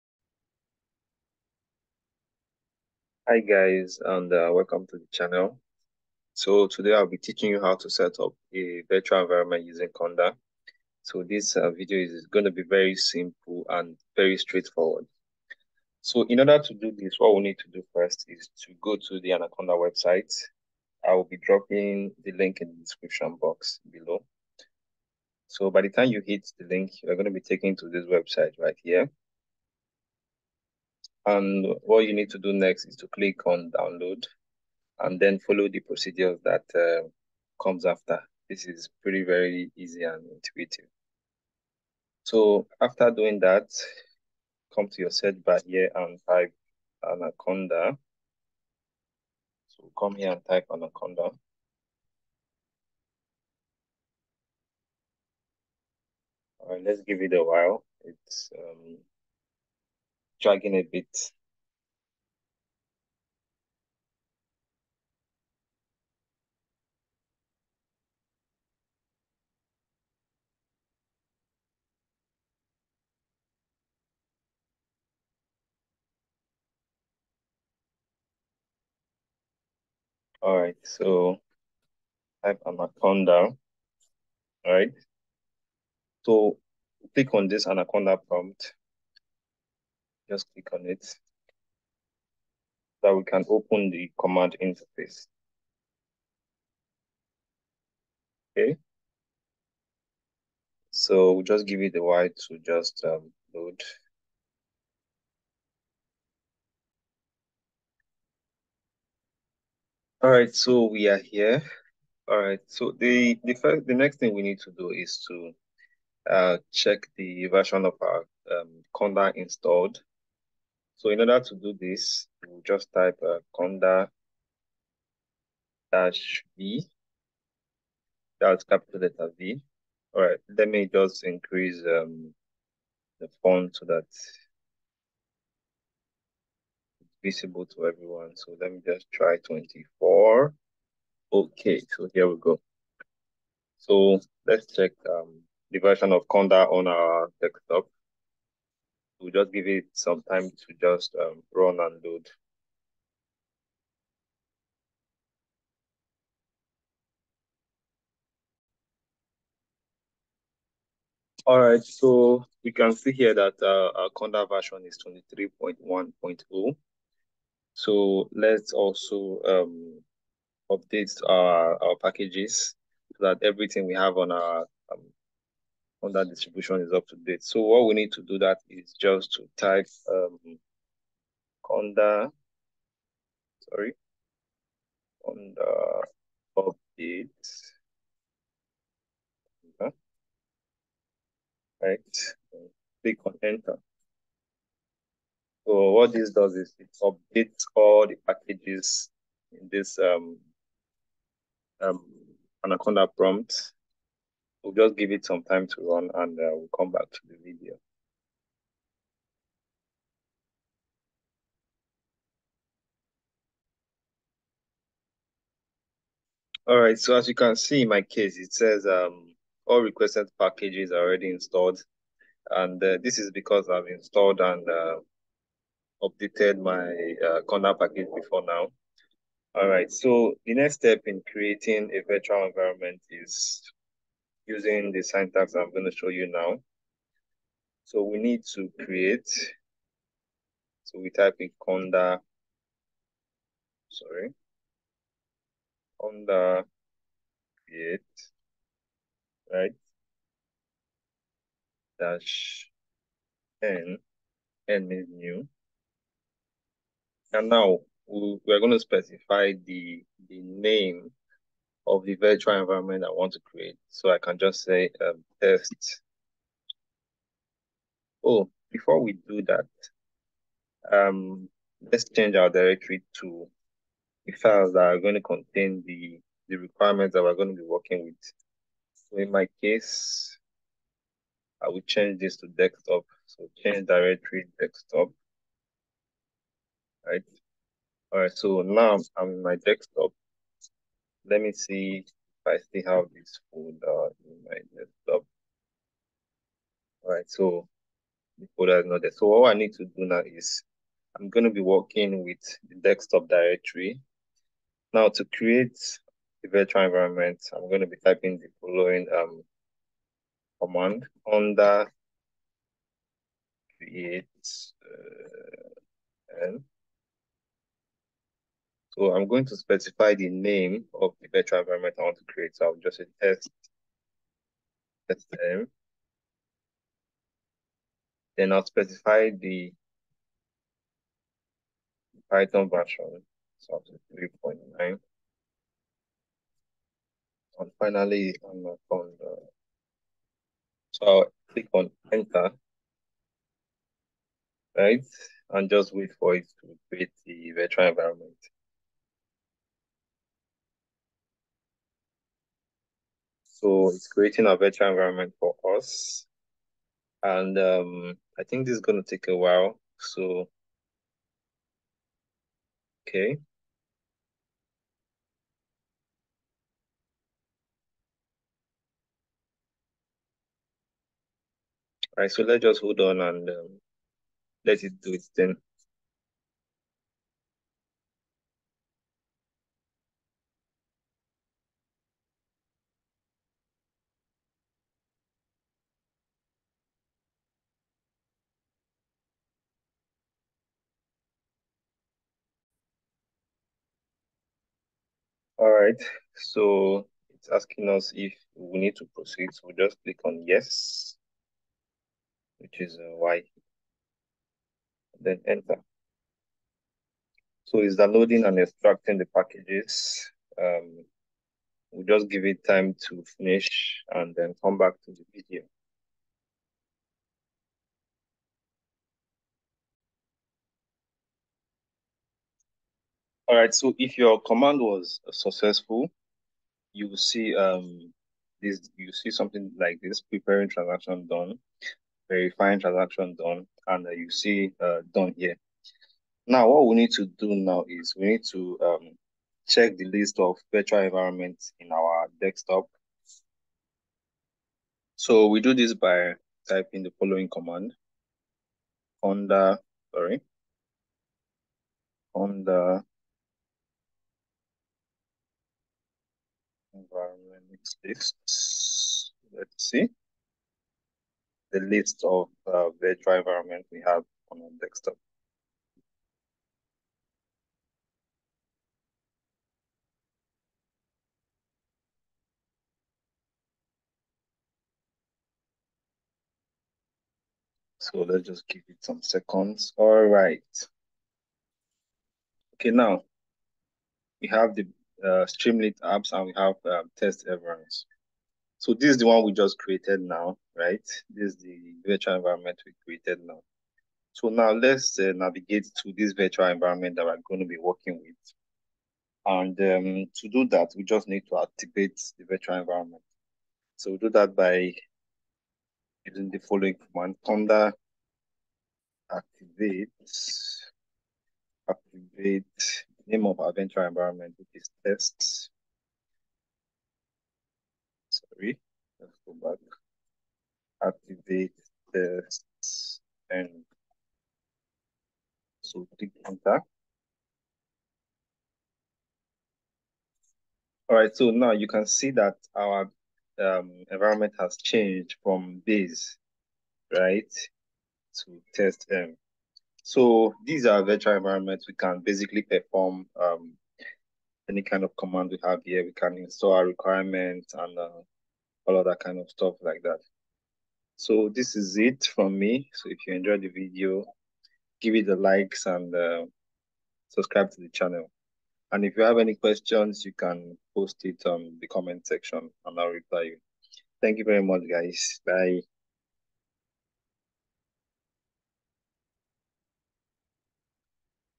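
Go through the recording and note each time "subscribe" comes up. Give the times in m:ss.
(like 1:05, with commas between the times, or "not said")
9:17.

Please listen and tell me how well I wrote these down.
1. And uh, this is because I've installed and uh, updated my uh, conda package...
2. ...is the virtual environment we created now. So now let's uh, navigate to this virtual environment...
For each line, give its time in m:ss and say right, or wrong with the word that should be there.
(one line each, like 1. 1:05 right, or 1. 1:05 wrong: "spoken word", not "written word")
1. 3:42 right
2. 8:11 right.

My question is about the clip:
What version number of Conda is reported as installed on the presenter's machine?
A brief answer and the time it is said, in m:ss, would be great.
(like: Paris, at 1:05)
23.1.0, at 2:45.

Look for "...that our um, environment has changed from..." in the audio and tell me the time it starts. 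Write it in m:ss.
8:52.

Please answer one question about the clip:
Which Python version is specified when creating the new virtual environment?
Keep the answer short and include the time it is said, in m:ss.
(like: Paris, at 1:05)
3.9, at 5:34.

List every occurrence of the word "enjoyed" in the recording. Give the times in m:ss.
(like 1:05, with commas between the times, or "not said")
9:13.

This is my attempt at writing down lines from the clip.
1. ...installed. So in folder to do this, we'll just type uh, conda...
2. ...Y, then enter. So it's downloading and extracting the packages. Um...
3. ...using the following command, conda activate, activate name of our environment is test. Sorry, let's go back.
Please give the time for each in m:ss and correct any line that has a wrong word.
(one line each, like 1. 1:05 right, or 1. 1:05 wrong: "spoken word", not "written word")
1. 1:59 wrong: "order", not "folder"
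2. 6:43 right
3. 8:26 right.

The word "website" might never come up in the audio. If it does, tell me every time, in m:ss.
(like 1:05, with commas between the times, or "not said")
0:19, 0:28.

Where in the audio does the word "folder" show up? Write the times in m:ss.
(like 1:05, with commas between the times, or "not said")
4:53, 4:58.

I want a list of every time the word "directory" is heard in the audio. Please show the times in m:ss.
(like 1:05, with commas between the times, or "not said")
4:32, 4:43, 5:03.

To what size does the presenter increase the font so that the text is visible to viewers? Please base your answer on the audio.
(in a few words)
24.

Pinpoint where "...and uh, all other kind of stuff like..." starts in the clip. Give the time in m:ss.
9:07.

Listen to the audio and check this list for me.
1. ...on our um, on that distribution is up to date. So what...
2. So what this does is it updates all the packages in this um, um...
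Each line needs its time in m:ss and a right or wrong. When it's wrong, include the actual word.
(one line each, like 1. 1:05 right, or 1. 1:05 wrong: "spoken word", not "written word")
1. 2:54 right
2. 3:15 right.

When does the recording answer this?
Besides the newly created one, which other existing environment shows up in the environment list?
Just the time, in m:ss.
8:05.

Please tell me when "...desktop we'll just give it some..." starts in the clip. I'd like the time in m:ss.
2:27.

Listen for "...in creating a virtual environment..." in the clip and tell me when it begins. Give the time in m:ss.
3:51.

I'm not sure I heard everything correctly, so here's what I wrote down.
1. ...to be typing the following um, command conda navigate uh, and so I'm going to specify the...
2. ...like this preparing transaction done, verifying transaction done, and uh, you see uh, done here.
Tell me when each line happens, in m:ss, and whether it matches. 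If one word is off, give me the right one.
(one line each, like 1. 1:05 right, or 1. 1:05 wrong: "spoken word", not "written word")
1. 5:07 wrong: "create", not "navigate"
2. 7:09 right.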